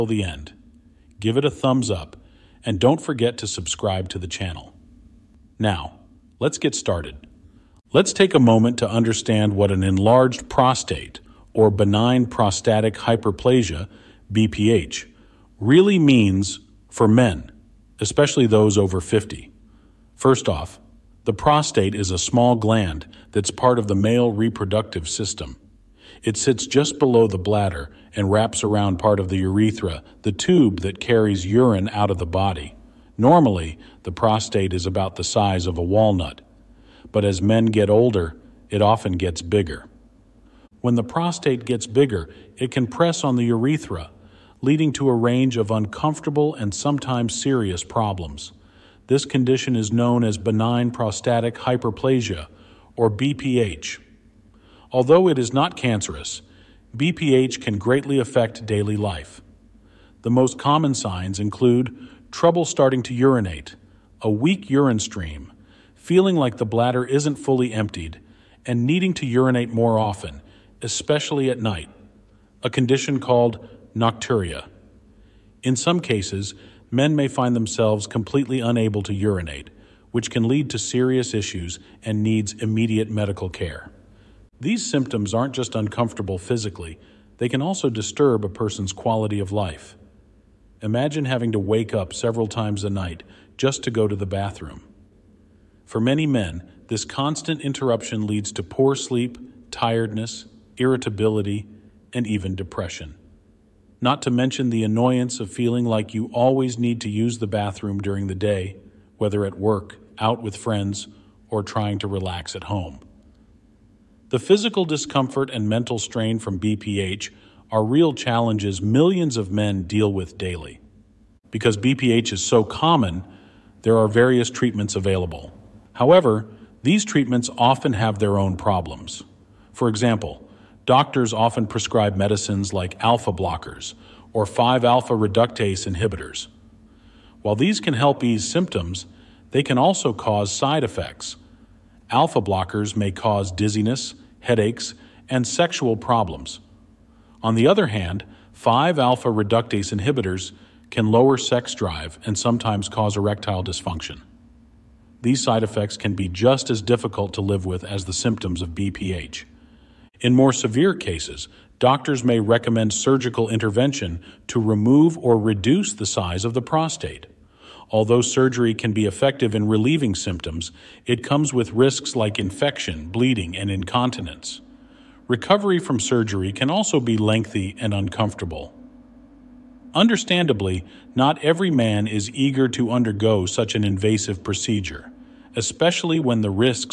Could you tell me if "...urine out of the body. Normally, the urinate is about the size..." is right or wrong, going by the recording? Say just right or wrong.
wrong.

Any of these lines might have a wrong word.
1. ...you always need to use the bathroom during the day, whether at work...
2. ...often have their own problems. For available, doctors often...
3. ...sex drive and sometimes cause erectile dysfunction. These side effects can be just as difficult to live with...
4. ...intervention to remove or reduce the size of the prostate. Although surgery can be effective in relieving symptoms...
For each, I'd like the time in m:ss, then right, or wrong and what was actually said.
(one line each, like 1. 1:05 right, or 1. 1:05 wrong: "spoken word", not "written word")
1. 1:46 right
2. 2:07 wrong: "example", not "available"
3. 2:31 right
4. 2:43 right.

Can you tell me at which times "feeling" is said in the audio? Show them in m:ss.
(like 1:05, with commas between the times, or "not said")
1:05, 1:45.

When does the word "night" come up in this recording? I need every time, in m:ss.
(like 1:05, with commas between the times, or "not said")
1:11, 1:32.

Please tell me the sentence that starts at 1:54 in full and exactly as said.
The physical discomfort and mental strain from BPH are real challenges millions of men deal with daily.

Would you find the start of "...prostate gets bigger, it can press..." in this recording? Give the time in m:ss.
0:41.